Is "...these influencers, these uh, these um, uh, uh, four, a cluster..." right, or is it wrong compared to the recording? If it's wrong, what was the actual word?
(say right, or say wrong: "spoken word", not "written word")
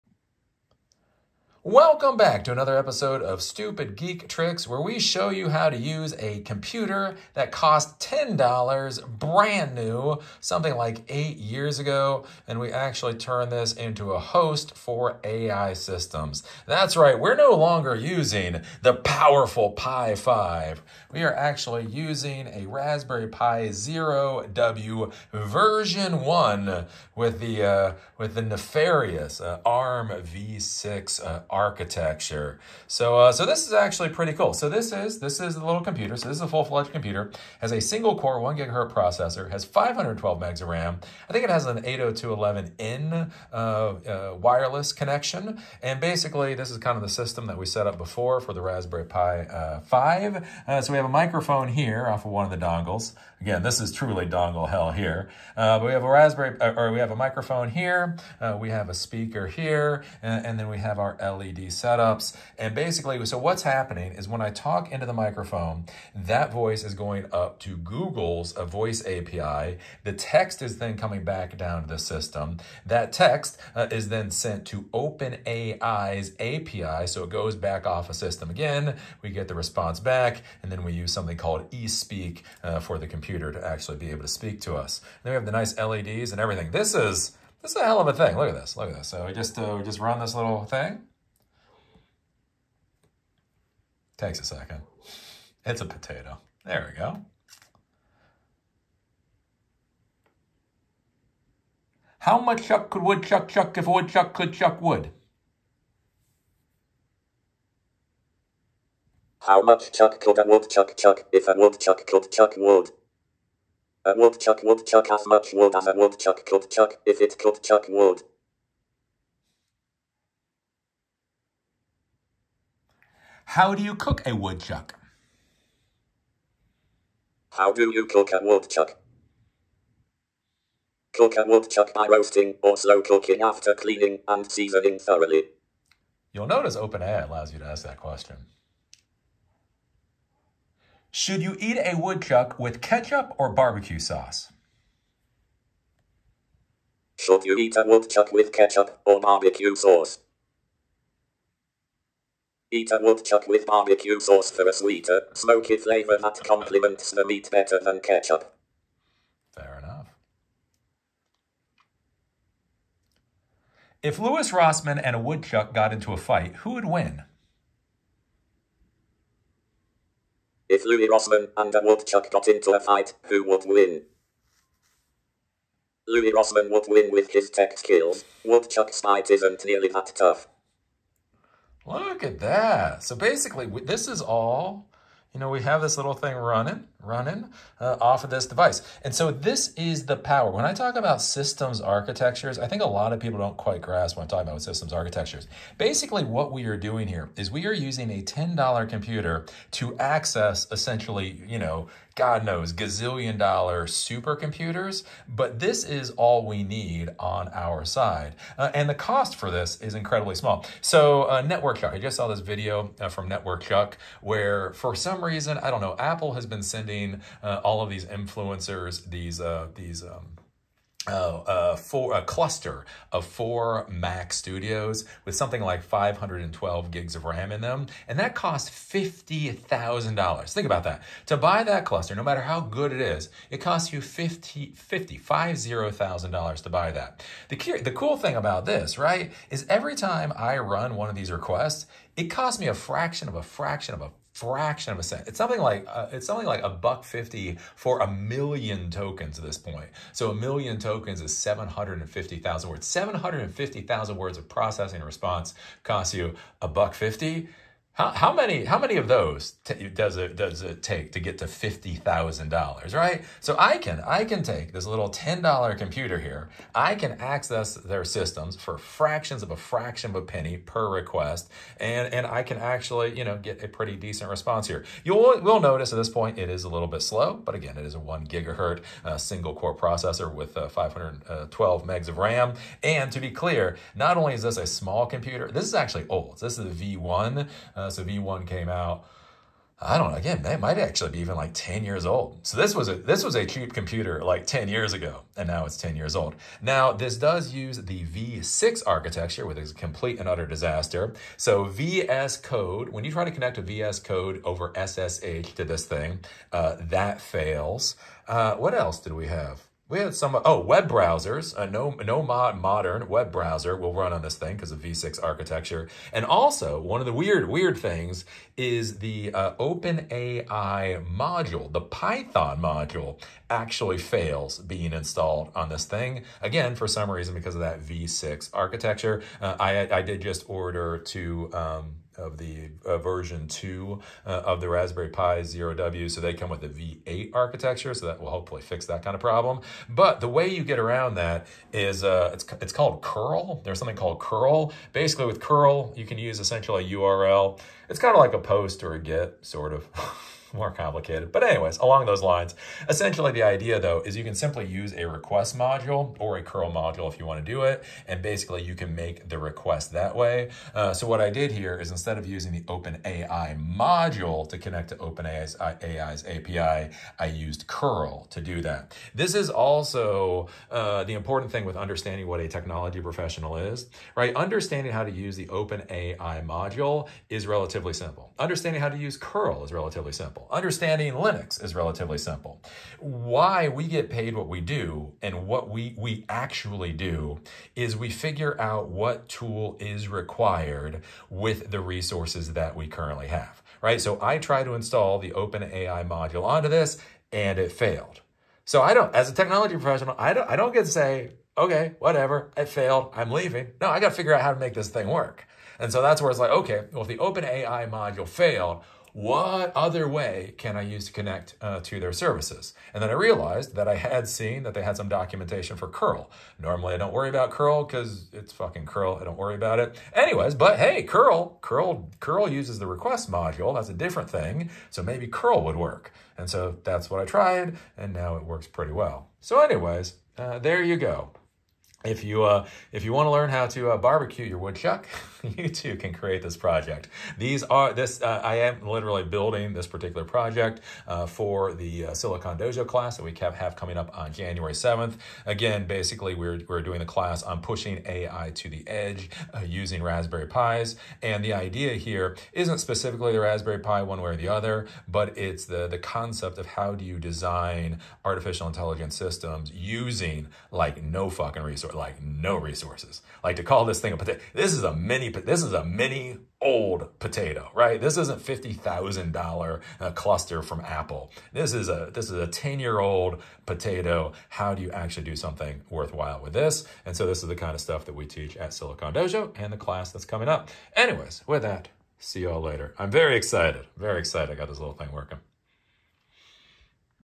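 right.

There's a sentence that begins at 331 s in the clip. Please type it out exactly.
Um, of the uh, version 2 uh, of the Raspberry Pi 0W.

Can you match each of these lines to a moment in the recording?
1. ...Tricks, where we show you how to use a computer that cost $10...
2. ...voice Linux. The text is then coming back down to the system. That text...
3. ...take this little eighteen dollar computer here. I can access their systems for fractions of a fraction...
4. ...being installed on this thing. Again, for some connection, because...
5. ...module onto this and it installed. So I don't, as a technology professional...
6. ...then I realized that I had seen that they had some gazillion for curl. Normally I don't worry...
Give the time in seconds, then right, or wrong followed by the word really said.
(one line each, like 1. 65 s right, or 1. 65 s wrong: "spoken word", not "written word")
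1. 4 s right
2. 68 s wrong: "API", not "Linux"
3. 264 s wrong: "ten", not "eighteen"
4. 324 s wrong: "reason", not "connection"
5. 396 s wrong: "failed", not "installed"
6. 413 s wrong: "documentation", not "gazillion".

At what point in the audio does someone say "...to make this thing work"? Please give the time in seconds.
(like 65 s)
404 s.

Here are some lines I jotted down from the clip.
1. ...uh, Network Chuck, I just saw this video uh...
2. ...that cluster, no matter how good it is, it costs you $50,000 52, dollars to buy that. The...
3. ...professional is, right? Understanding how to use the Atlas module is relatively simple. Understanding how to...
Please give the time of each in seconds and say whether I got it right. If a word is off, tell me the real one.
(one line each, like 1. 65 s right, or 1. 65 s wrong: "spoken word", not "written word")
1. 211 s right
2. 231 s wrong: "50", not "52"
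3. 373 s wrong: "OpenAI", not "Atlas".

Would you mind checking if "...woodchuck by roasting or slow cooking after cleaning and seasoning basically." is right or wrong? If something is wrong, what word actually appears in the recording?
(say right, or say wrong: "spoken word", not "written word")
wrong: "thoroughly", not "basically".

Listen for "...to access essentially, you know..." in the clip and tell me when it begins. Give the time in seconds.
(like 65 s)
199 s.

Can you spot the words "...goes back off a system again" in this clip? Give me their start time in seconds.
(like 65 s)
77 s.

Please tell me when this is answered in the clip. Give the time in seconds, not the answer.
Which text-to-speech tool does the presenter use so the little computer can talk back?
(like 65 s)
81 s.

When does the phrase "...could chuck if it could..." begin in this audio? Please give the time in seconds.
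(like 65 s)
116 s.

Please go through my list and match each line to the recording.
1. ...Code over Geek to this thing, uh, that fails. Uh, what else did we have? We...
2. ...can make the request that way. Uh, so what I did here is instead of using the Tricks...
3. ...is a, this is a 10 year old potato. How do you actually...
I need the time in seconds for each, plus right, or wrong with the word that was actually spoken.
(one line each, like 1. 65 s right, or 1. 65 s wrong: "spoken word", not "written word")
1. 304 s wrong: "SSH", not "Geek"
2. 358 s wrong: "OpenAI", not "Tricks"
3. 471 s right.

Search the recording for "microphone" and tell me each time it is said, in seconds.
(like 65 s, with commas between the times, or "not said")
51 s, 57 s, 65 s.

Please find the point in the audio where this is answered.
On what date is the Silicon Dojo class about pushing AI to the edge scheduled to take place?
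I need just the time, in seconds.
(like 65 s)
444 s.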